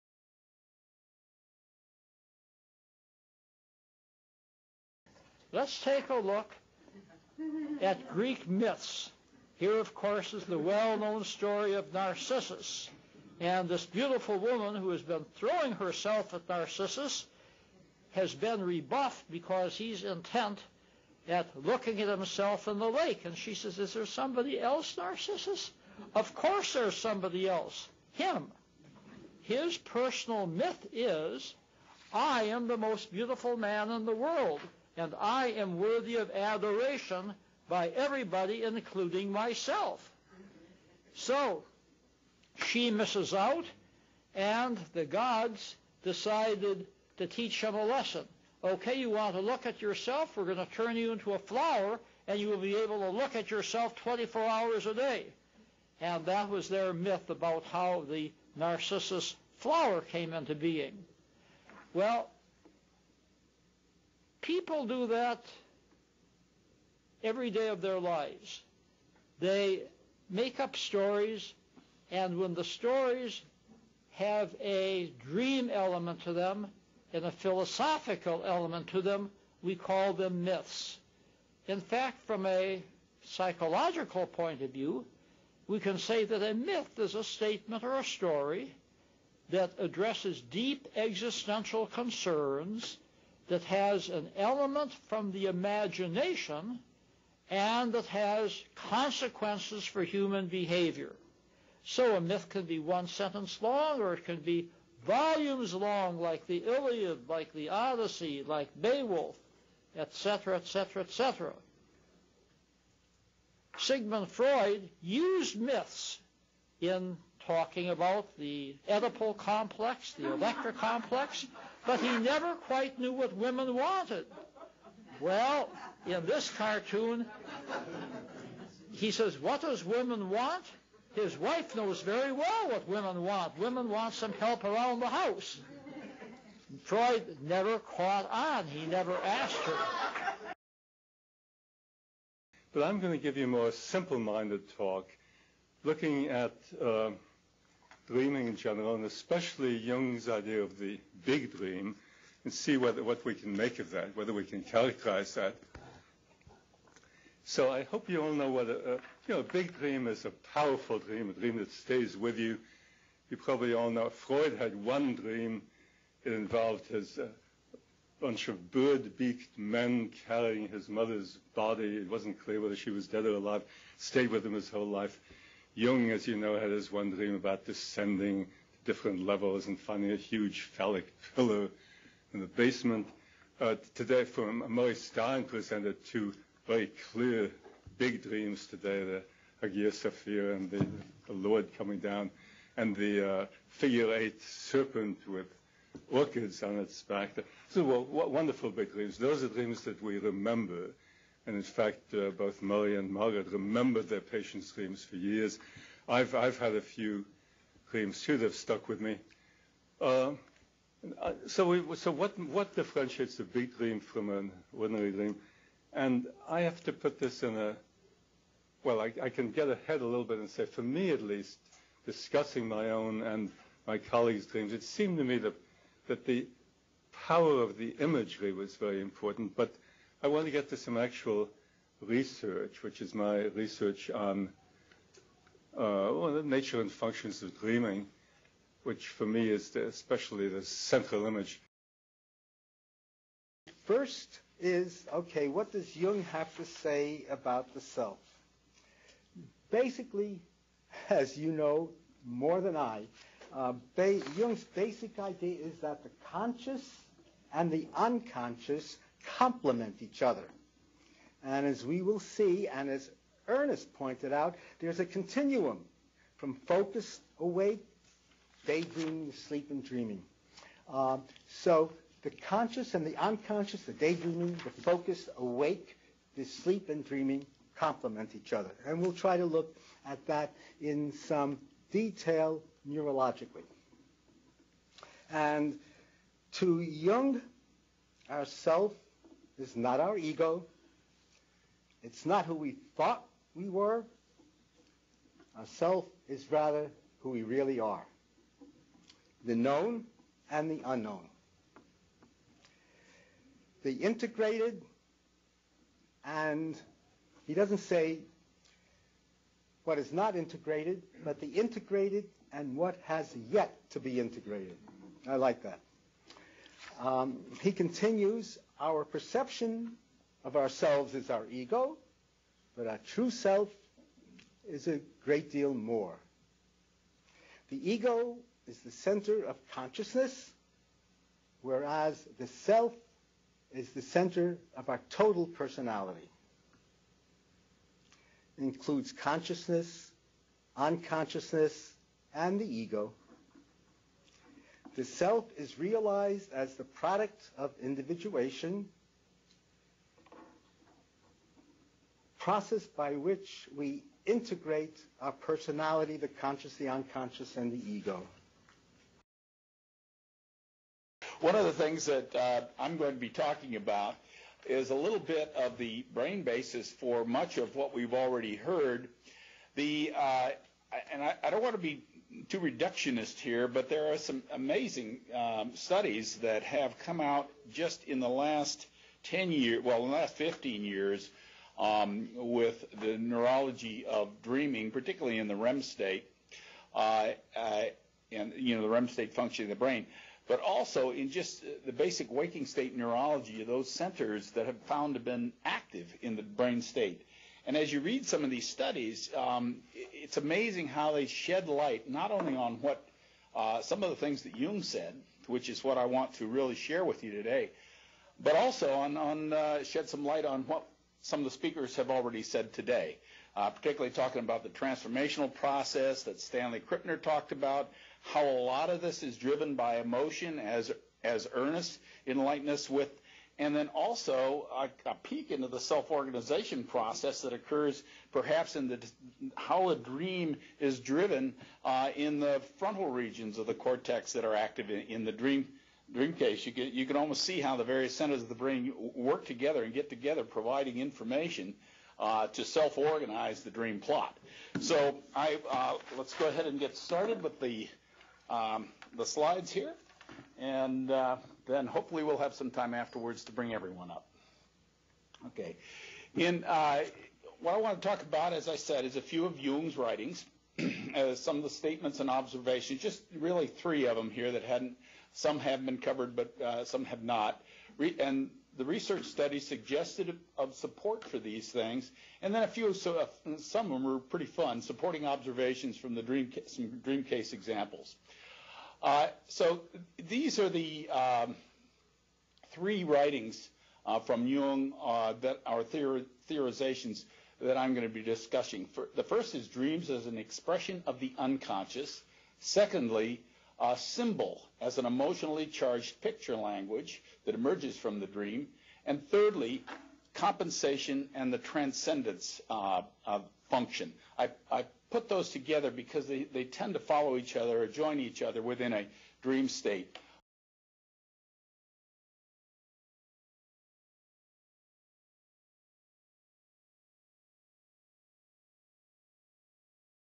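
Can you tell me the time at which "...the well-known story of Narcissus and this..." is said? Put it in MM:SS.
00:10.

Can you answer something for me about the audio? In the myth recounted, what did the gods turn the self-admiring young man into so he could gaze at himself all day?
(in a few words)
A flower.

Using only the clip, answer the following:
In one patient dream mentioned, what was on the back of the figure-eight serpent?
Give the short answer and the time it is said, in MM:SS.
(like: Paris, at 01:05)
Orchids, at 03:16.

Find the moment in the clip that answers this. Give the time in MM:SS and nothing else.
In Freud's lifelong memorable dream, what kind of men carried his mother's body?
02:48.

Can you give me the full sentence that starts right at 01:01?
Well, People do that every day of their lives.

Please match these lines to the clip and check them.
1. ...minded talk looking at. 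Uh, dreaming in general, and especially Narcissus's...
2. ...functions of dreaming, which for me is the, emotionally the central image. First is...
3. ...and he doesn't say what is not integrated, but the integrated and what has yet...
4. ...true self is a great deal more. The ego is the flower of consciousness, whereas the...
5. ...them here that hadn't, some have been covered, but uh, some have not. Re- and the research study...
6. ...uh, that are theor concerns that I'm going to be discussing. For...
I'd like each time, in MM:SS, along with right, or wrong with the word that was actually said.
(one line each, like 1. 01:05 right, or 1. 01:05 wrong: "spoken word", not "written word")
1. 02:24 wrong: "Jung", not "Narcissus"
2. 03:56 wrong: "especially", not "emotionally"
3. 05:06 right
4. 05:22 wrong: "center", not "flower"
5. 07:44 right
6. 08:05 wrong: "theorizations", not "concerns".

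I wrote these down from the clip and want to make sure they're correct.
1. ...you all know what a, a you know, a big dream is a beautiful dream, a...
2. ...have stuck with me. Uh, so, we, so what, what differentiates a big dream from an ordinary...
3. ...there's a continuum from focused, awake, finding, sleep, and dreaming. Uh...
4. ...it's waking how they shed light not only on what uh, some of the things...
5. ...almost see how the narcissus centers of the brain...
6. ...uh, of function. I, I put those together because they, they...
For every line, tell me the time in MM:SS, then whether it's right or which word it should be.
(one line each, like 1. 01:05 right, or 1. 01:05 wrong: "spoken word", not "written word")
1. 02:38 wrong: "powerful", not "beautiful"
2. 03:28 right
3. 04:24 wrong: "daydreaming", not "finding"
4. 06:39 wrong: "amazing", not "waking"
5. 07:17 wrong: "various", not "narcissus"
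6. 08:22 right.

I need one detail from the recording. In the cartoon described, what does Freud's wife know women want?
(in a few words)
Some help around the house.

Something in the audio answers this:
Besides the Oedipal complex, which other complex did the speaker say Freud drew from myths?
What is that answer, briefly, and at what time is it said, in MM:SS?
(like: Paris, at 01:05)
Electra complex, at 02:00.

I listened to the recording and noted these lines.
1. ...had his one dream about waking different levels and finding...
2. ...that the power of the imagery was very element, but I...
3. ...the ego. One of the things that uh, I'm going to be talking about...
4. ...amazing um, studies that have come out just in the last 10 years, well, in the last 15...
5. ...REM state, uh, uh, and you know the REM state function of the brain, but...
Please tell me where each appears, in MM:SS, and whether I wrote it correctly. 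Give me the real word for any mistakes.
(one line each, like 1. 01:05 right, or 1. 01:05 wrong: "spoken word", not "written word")
1. 02:56 wrong: "descending", not "waking"
2. 03:46 wrong: "important", not "element"
3. 05:57 right
4. 06:14 right
5. 06:25 right.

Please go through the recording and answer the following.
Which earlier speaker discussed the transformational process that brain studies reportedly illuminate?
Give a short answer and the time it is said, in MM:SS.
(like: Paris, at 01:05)
Stanley Krippner, at 06:56.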